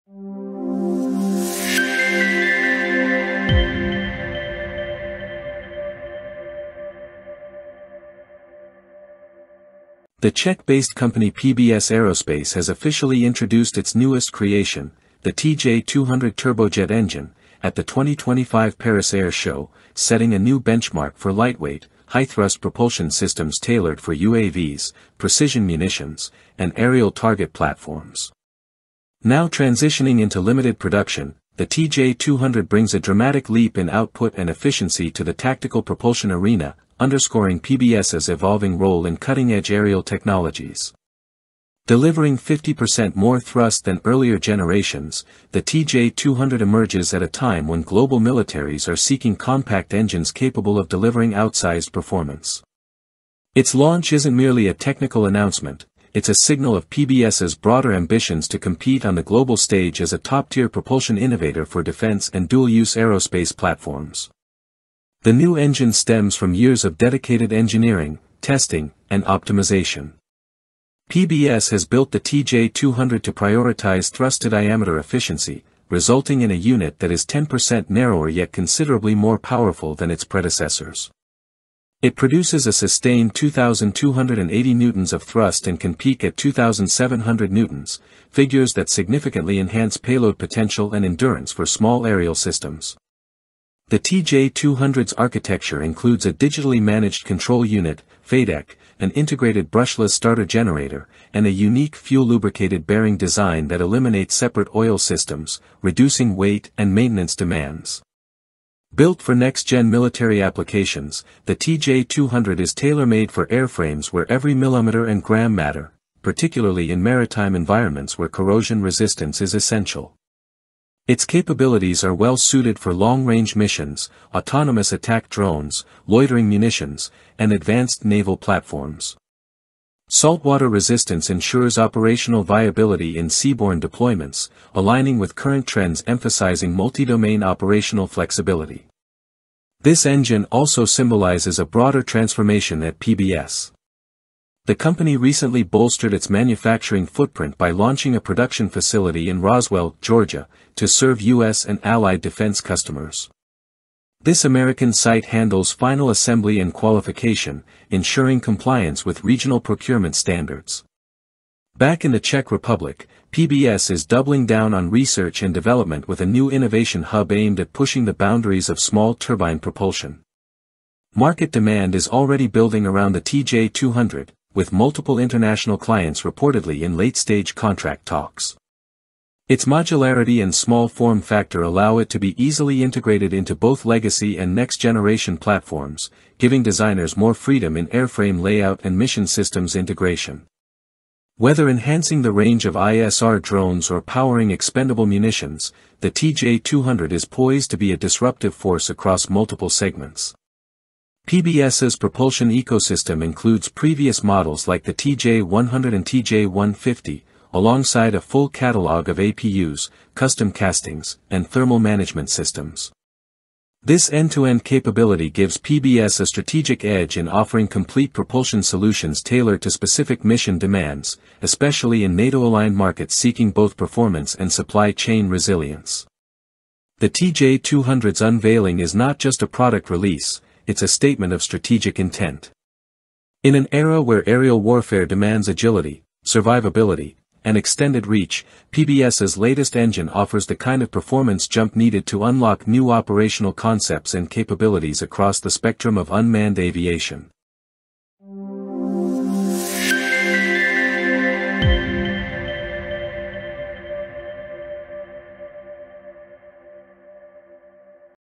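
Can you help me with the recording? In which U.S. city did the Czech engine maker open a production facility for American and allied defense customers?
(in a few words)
Roswell, Georgia.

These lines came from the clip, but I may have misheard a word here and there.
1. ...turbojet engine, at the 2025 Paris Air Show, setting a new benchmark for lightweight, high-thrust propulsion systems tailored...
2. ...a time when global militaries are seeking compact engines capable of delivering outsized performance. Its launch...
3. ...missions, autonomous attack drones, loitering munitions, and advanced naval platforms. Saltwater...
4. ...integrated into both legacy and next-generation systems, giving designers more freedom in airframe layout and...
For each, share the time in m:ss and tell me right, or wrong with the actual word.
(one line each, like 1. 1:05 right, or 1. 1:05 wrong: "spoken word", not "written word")
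1. 0:16 right
2. 0:47 right
3. 2:03 right
4. 3:02 wrong: "platforms", not "systems".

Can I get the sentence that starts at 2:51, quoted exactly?
Market demand is already building around the TJ200, with multiple international clients reportedly in late-stage contract talks.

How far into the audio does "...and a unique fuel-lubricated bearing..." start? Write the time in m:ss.
1:41.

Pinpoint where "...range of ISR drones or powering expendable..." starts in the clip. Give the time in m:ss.
3:12.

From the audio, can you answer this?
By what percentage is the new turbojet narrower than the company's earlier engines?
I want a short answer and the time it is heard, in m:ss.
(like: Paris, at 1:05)
10%, at 1:17.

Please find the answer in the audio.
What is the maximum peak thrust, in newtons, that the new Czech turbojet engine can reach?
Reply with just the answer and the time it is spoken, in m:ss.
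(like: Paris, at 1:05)
2,700 newtons, at 1:26.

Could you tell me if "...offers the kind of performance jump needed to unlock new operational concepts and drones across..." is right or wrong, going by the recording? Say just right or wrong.
wrong.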